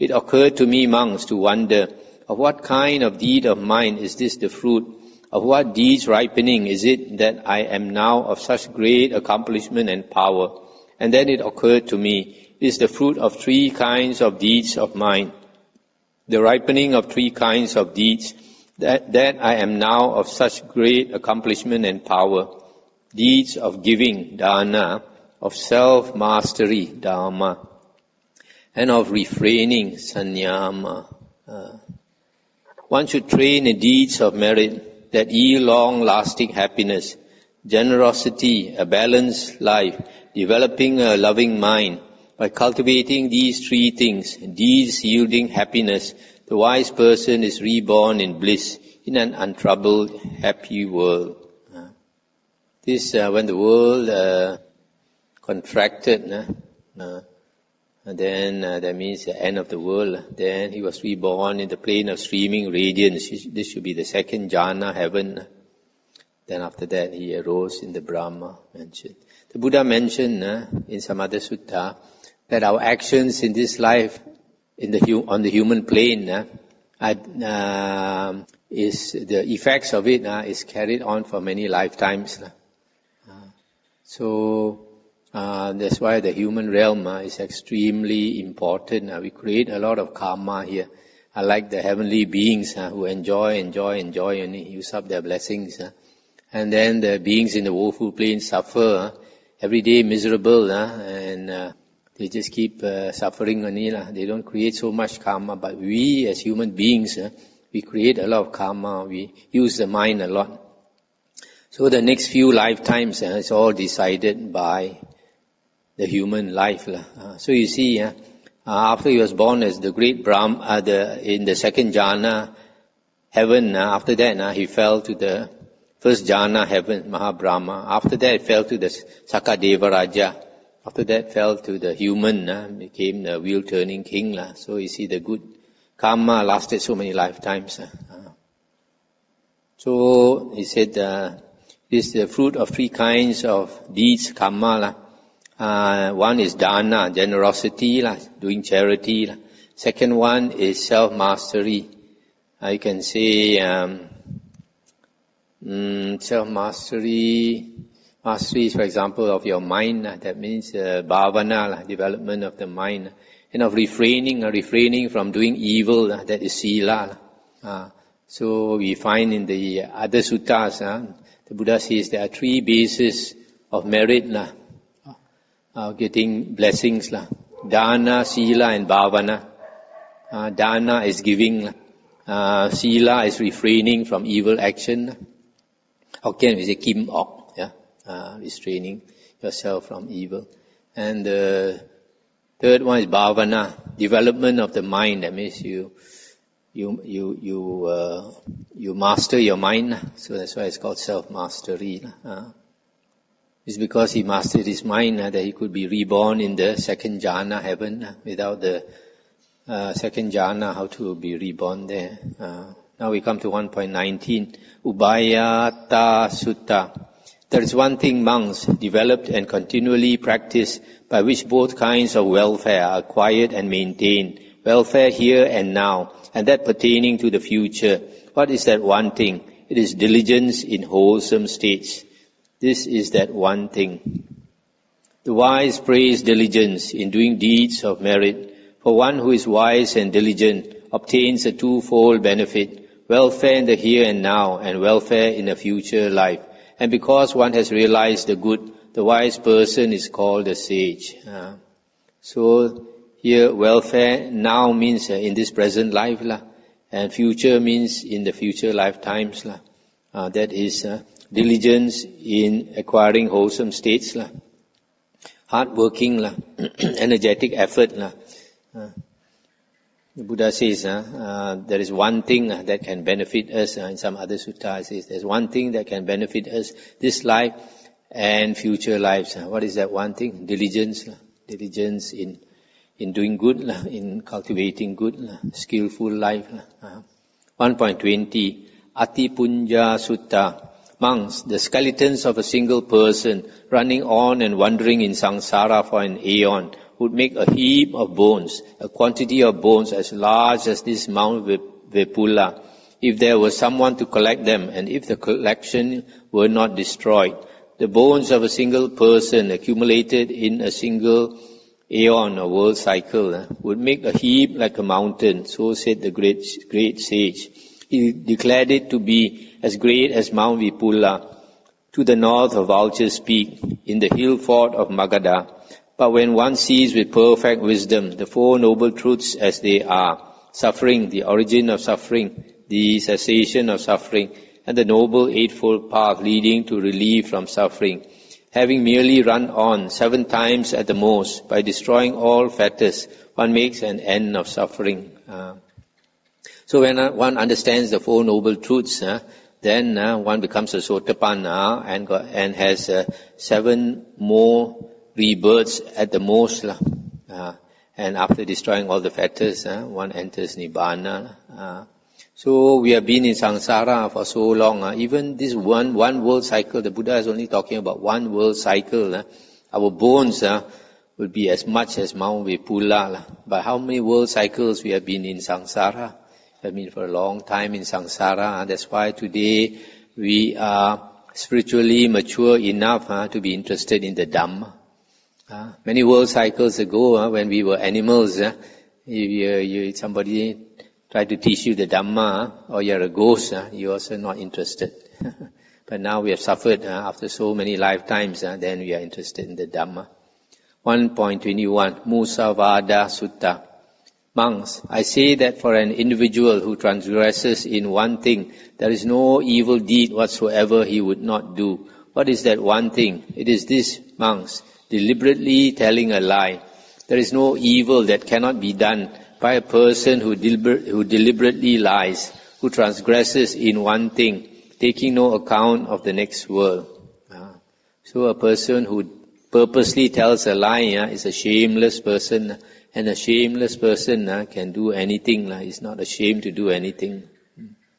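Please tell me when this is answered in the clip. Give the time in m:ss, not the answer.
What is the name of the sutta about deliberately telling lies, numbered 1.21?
6:42.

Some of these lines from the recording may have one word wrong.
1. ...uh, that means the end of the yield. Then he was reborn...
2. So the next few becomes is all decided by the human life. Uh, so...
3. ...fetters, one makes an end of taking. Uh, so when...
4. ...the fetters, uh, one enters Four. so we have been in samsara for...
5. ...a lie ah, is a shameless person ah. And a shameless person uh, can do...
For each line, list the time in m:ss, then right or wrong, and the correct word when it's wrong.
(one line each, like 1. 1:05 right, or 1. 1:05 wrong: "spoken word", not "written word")
1. 0:58 wrong: "world", not "yield"
2. 1:51 wrong: "lifetimes", not "becomes"
3. 5:42 wrong: "suffering", not "taking"
4. 5:58 wrong: "Nibbana", not "Four"
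5. 7:10 right.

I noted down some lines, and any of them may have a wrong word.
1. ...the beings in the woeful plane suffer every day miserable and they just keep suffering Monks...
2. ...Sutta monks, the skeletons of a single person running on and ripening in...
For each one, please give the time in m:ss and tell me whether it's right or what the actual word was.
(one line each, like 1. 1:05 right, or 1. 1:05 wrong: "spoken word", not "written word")
1. 1:37 wrong: "They", not "Monks"
2. 4:50 wrong: "wandering", not "ripening".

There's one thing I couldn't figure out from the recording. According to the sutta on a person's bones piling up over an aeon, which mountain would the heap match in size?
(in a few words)
Mount Vepula.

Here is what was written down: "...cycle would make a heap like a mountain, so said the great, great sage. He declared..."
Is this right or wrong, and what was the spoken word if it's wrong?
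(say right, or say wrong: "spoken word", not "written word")
right.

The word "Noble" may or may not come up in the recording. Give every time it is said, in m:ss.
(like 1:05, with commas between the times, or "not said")
5:28, 5:34, 5:48.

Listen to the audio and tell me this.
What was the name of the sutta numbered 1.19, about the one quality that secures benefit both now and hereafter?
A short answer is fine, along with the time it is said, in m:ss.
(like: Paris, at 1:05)
Ubhayattha Sutta, at 3:34.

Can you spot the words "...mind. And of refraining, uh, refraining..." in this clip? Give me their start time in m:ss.
2:42.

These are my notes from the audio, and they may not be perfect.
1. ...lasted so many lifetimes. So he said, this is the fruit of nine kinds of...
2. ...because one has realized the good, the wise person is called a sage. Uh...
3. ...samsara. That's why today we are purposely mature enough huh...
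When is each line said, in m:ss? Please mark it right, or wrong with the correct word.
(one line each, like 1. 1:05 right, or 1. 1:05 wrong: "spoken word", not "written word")
1. 2:16 wrong: "three", not "nine"
2. 4:06 right
3. 6:17 wrong: "spiritually", not "purposely".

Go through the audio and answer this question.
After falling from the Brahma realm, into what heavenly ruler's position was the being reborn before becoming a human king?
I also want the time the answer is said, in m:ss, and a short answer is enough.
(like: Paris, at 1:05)
Sakadeva Raja, at 2:08.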